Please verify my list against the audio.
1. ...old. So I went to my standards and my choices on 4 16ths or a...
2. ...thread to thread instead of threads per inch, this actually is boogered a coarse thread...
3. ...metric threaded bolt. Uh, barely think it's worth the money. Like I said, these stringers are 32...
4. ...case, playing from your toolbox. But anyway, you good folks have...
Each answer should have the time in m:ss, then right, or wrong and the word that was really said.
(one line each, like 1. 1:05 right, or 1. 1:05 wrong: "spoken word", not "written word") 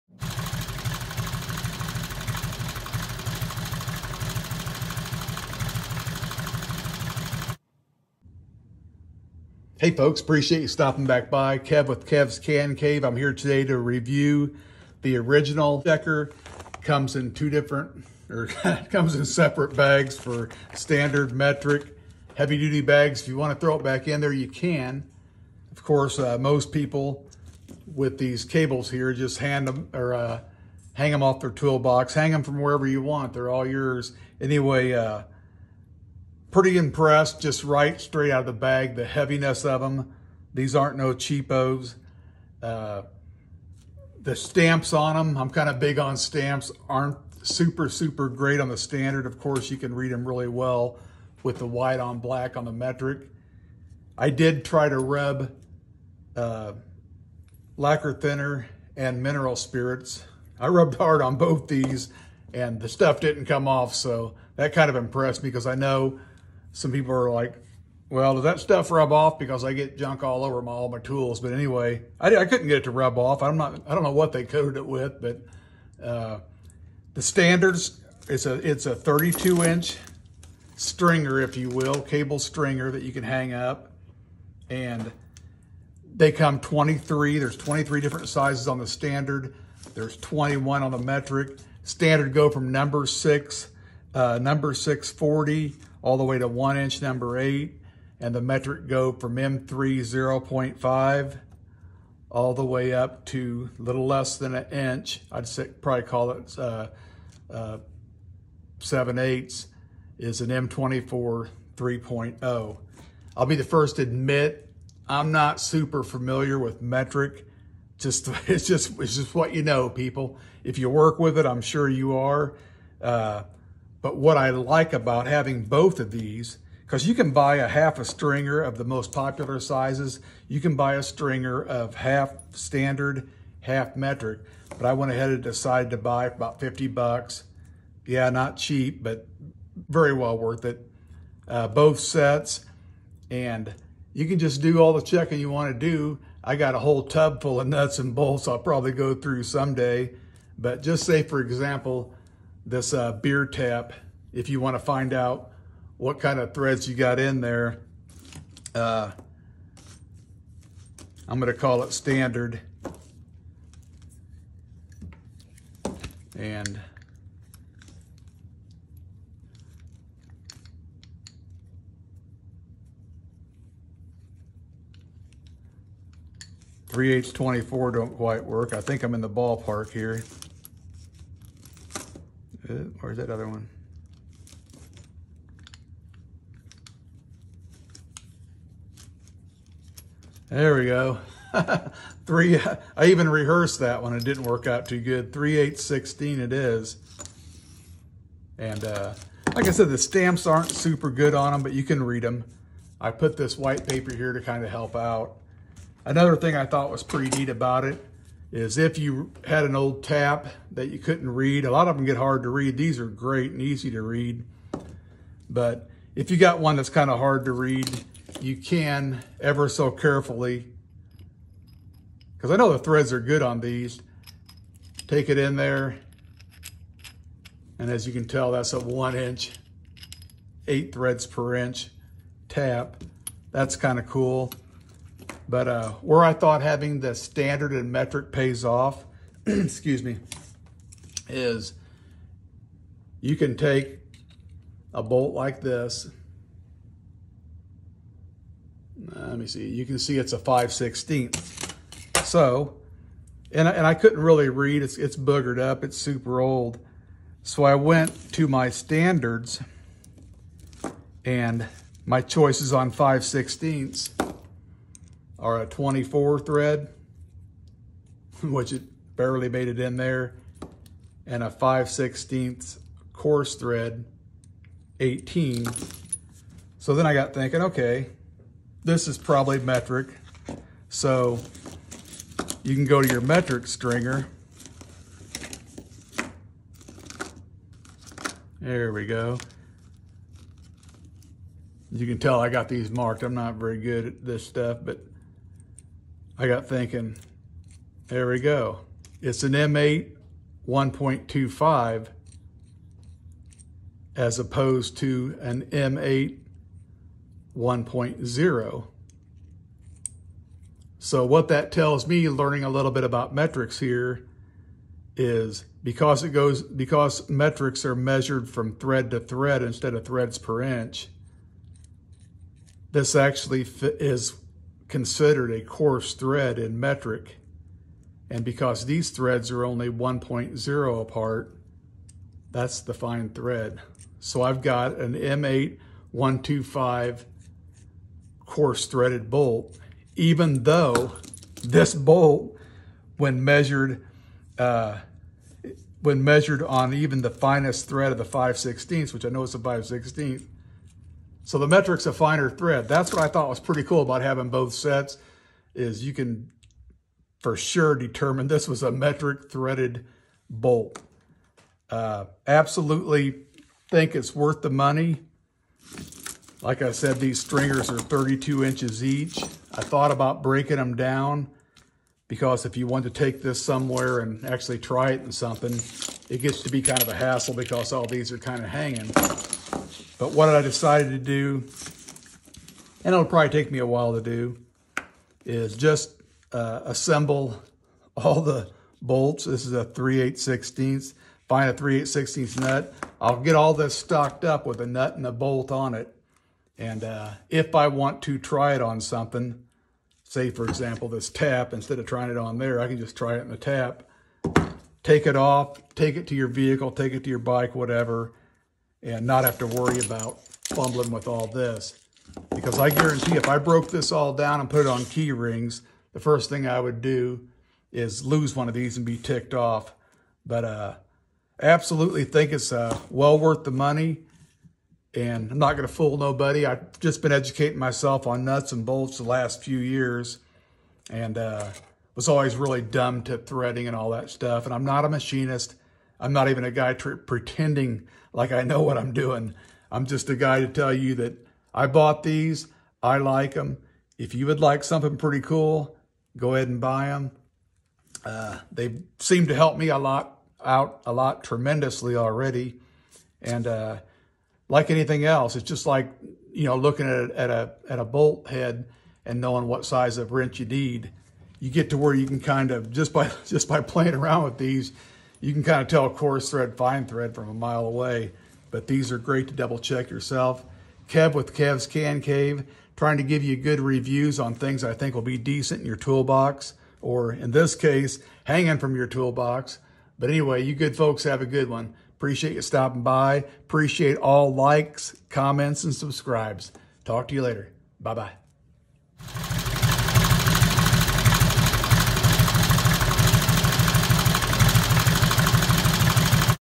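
1. 4:16 wrong: "5", not "4"
2. 5:18 wrong: "considered", not "boogered"
3. 5:58 wrong: "absolutely", not "barely"
4. 7:57 wrong: "hanging", not "playing".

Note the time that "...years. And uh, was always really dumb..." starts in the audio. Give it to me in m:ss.
7:09.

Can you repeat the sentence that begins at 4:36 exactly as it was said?
So then I got thinking, okay, this is probably metric.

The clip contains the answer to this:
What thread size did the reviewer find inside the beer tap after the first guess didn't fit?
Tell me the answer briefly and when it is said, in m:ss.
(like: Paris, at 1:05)
3/8-16, at 3:15.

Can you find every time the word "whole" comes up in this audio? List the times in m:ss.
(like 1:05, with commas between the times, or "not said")
2:26.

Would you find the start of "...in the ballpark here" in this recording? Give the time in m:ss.
2:59.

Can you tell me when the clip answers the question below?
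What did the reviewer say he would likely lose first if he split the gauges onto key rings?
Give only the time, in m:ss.
6:58.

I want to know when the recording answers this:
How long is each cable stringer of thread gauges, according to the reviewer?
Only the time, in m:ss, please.
1:18.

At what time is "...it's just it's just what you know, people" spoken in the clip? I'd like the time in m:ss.
1:58.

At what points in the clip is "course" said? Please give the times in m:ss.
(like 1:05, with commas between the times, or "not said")
0:25, 0:49.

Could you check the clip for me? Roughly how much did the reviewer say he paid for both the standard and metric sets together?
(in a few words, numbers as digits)
$50.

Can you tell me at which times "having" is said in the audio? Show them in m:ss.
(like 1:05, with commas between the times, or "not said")
2:05, 3:56, 5:54.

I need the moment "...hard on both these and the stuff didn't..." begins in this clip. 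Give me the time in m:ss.
1:00.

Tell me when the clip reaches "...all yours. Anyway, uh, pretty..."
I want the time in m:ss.
0:33.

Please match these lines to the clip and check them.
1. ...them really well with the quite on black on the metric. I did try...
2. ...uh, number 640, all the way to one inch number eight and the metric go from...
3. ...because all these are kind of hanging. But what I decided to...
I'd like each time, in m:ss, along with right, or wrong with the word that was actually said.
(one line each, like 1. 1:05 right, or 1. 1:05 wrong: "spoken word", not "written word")
1. 0:50 wrong: "white", not "quite"
2. 1:34 right
3. 6:17 right.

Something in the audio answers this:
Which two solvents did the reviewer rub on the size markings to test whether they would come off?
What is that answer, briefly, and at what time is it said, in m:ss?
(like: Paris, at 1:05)
lacquer thinner and mineral spirits, at 0:57.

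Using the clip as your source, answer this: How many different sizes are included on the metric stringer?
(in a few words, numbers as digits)
21.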